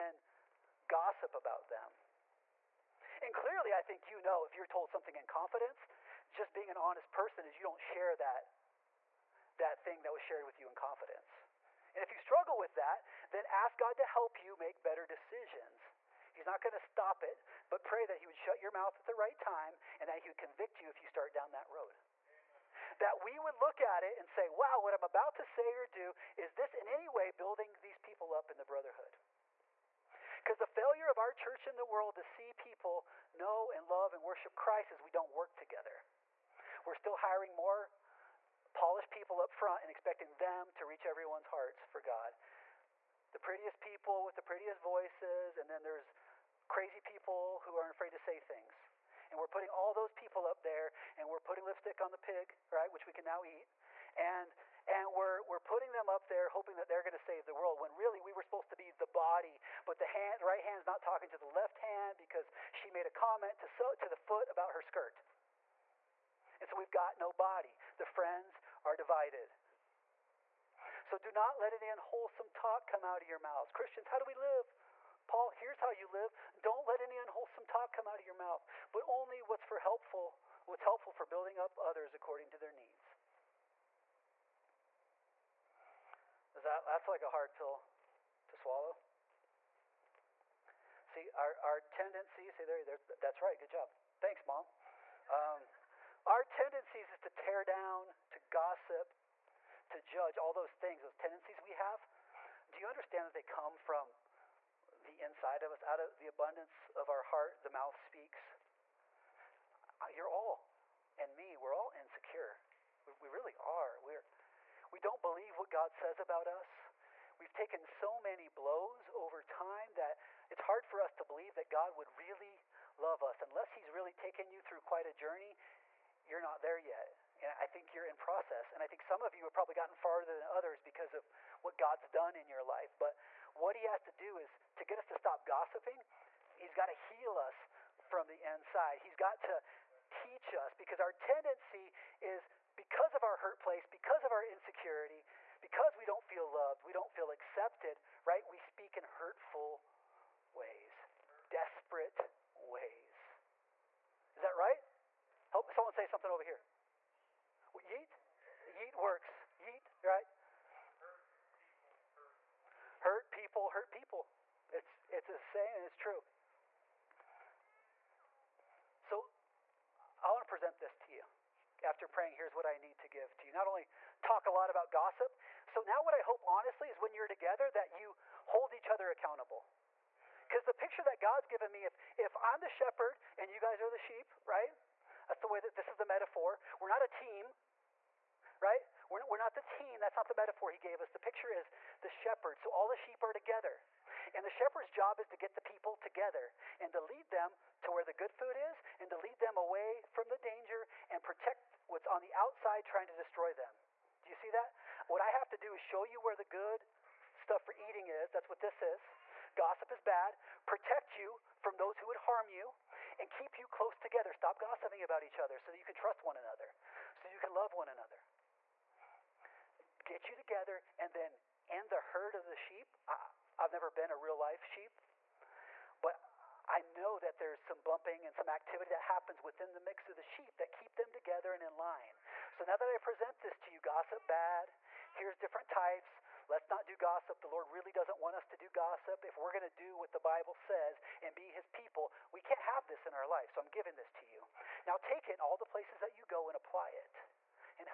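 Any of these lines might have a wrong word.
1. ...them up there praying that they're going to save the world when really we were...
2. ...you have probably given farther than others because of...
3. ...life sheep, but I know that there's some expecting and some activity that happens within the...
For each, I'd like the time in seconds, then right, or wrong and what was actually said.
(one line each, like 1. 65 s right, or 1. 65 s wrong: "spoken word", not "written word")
1. 55 s wrong: "hoping", not "praying"
2. 129 s wrong: "gotten", not "given"
3. 224 s wrong: "bumping", not "expecting".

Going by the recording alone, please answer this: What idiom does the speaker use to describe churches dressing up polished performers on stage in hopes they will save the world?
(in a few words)
Lipstick on the pig.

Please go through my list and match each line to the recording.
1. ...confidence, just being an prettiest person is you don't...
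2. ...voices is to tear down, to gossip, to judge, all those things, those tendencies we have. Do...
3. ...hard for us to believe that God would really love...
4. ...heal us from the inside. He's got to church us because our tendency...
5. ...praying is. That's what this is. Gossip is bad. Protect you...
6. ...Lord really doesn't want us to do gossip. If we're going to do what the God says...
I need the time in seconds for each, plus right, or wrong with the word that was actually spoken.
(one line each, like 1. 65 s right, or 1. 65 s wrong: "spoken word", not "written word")
1. 5 s wrong: "honest", not "prettiest"
2. 96 s wrong: "tendencies", not "voices"
3. 120 s right
4. 136 s wrong: "teach", not "church"
5. 207 s wrong: "eating", not "praying"
6. 237 s wrong: "Bible", not "God".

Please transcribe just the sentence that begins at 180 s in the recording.
Because the picture that God's given me, if, if I'm the shepherd and you guys are the sheep, right?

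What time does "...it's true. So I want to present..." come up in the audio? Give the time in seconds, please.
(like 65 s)
165 s.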